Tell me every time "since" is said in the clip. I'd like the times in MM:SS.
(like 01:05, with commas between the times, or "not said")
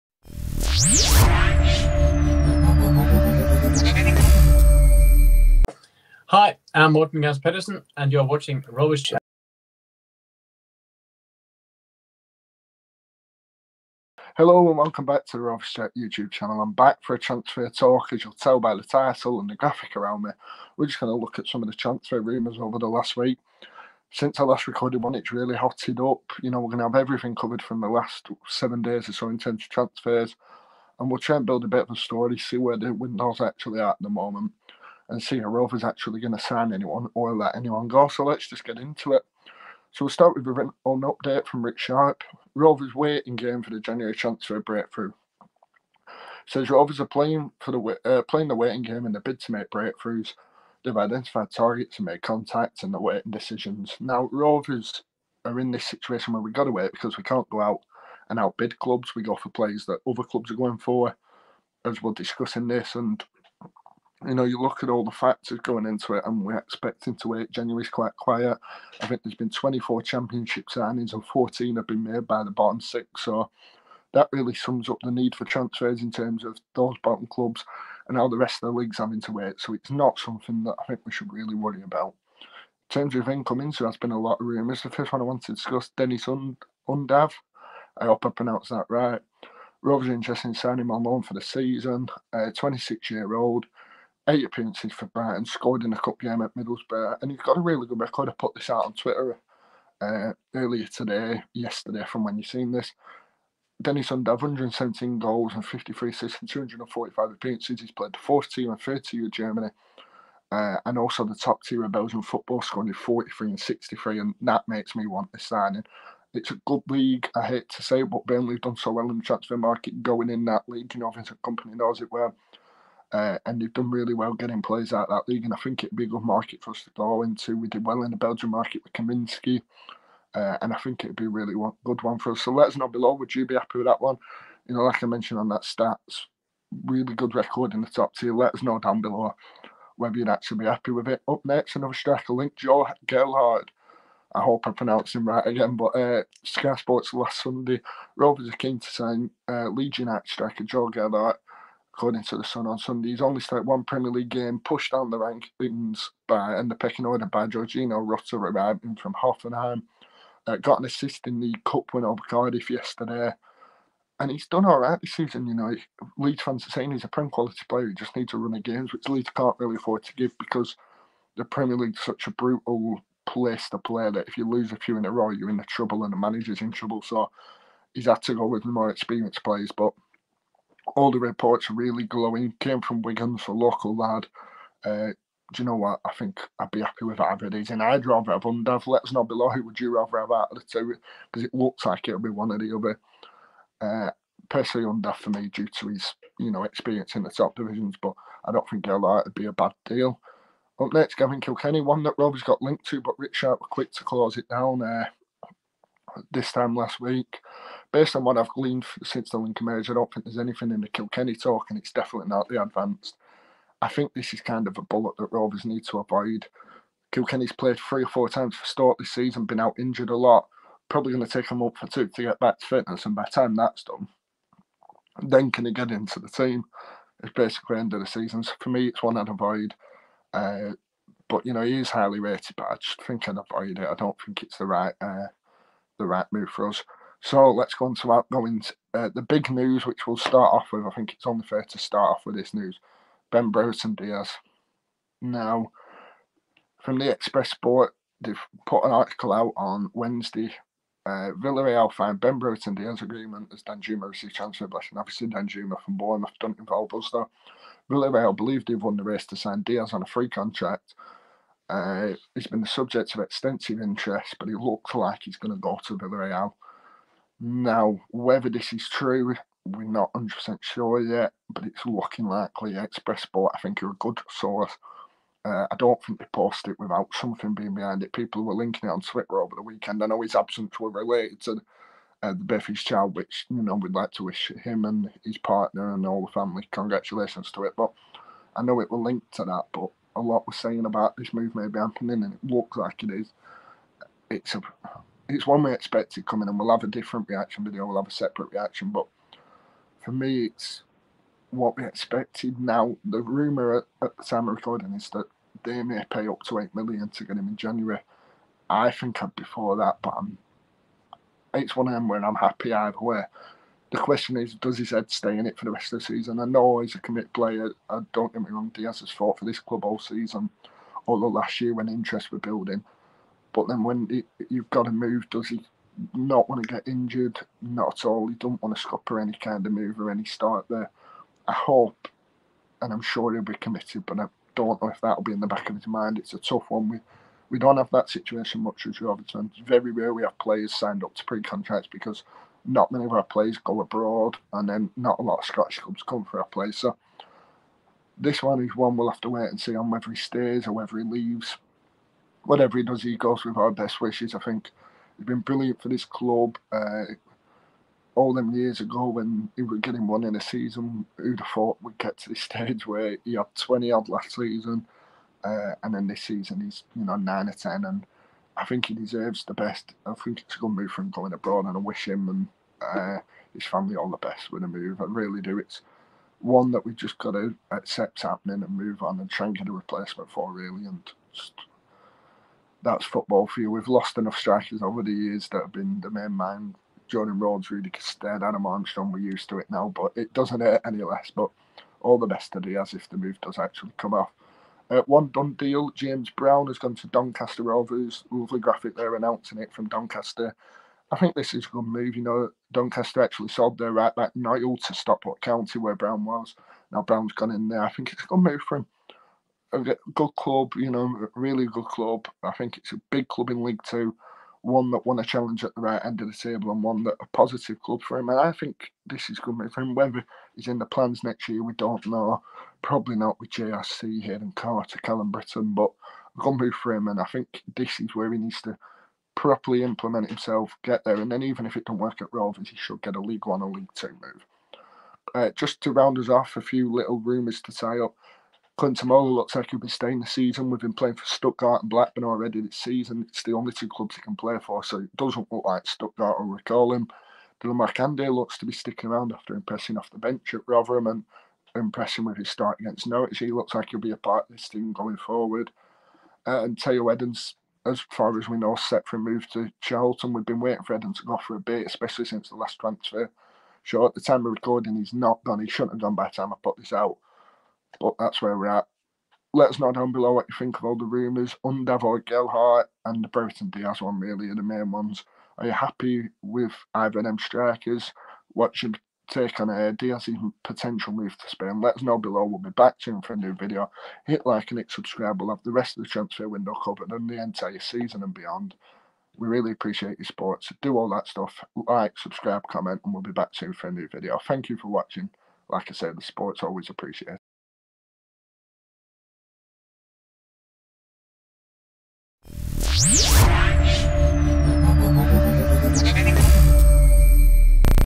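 00:24, 03:29, 07:42.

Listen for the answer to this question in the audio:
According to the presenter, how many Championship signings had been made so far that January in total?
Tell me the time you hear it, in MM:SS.
01:09.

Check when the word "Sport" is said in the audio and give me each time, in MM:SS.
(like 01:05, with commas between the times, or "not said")
02:26, 04:07, 04:33.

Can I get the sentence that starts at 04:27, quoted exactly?
Now, whether this is true, we're not 100% sure yet, but it's looking likely.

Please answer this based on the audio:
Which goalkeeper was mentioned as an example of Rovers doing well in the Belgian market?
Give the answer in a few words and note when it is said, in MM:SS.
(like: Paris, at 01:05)
Kaminski, at 02:08.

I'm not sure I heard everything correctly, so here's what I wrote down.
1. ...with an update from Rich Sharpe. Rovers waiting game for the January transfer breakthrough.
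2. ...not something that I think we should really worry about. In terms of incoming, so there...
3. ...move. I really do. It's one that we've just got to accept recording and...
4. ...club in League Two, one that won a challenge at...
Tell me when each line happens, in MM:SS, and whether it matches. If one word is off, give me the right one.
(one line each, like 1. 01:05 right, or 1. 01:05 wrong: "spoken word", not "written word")
1. 00:40 right
2. 01:19 right
3. 06:14 wrong: "happening", not "recording"
4. 06:53 right.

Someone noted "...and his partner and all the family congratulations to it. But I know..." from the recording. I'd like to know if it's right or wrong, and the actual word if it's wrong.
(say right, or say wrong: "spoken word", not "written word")
right.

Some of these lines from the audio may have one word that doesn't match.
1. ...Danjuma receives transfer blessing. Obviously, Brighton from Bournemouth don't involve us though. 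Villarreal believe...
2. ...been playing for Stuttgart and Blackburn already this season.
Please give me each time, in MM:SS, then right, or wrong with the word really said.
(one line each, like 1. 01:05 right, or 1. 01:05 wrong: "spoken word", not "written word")
1. 04:13 wrong: "Danjuma", not "Brighton"
2. 07:20 right.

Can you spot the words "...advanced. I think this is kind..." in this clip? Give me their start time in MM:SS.
03:32.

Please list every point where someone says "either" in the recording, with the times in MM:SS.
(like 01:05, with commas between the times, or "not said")
03:07, 05:12, 07:56.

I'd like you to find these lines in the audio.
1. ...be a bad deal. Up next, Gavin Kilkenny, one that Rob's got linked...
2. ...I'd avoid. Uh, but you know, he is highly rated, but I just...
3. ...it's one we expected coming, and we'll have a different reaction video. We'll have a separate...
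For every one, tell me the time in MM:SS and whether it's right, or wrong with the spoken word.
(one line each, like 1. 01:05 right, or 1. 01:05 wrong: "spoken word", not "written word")
1. 03:19 right
2. 03:49 right
3. 04:55 right.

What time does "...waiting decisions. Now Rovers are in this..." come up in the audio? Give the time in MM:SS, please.
00:53.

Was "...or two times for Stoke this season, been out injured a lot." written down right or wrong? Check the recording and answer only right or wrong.
wrong.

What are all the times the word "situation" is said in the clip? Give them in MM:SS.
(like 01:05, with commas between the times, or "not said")
00:55, 05:38.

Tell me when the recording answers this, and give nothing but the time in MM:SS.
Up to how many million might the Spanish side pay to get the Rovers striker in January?
05:06.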